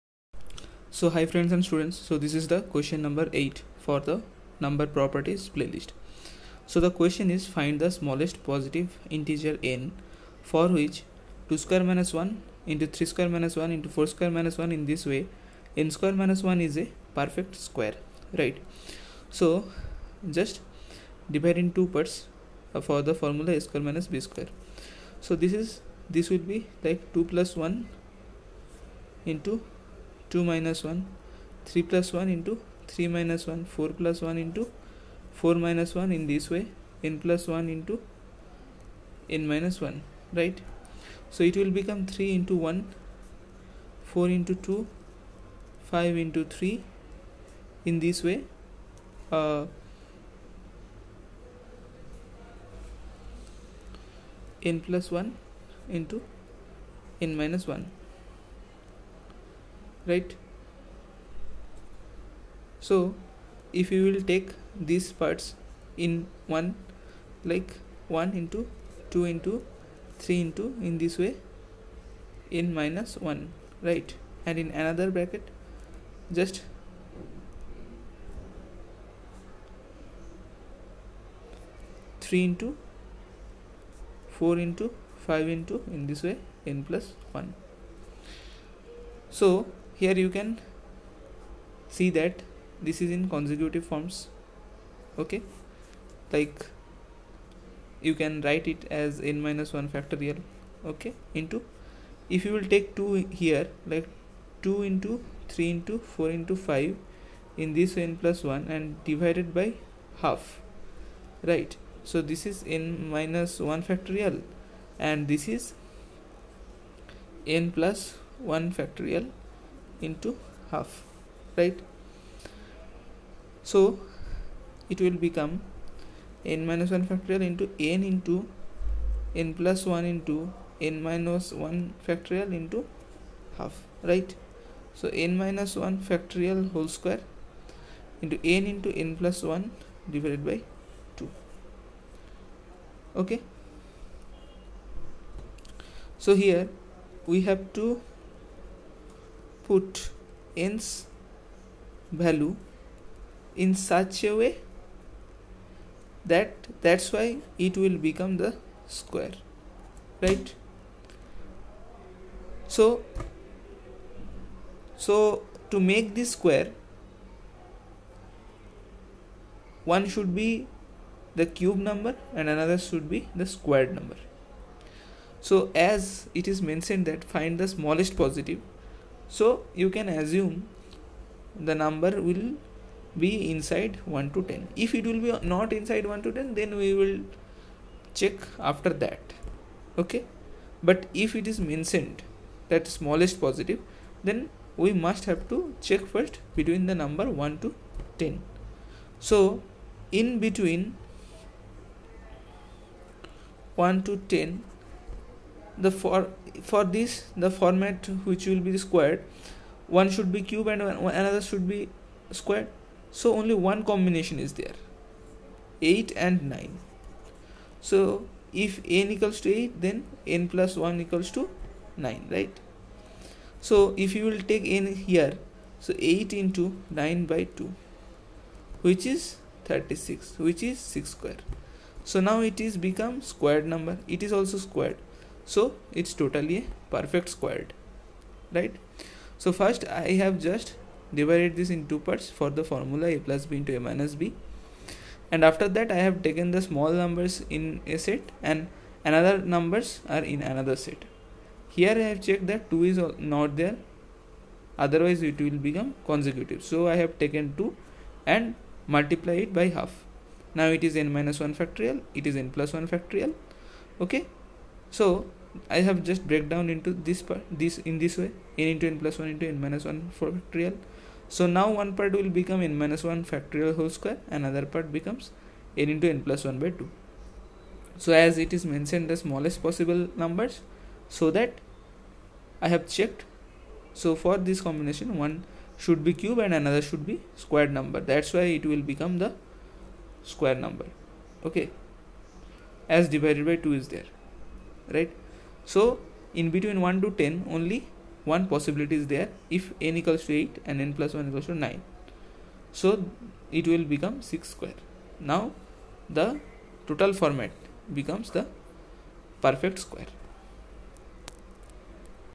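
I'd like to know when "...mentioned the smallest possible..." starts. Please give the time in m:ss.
4:38.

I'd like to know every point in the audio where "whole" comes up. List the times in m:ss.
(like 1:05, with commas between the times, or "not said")
2:16, 4:33.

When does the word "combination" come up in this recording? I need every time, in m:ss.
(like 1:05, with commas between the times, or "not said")
3:33, 4:44.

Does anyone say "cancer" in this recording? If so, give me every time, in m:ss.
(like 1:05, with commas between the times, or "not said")
not said.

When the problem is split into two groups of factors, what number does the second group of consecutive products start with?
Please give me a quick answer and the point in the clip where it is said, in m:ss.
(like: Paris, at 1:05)
3, at 1:22.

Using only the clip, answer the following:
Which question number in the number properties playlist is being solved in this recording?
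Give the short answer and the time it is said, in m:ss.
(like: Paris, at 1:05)
8, at 0:02.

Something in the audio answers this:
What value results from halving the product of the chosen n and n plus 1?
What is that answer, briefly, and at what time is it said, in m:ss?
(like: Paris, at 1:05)
36, at 3:49.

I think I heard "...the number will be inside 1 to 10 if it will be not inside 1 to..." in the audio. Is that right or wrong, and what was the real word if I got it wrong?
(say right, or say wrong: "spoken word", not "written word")
right.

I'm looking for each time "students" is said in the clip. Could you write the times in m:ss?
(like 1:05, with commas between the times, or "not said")
0:01.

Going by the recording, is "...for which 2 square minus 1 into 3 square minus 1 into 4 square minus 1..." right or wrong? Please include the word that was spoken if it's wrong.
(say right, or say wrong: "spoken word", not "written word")
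right.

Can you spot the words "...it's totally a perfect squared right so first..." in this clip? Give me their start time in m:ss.
3:56.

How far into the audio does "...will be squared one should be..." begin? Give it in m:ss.
3:28.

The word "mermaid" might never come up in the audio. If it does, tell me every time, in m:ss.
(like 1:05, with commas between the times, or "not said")
not said.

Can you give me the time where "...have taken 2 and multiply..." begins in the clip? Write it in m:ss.
4:17.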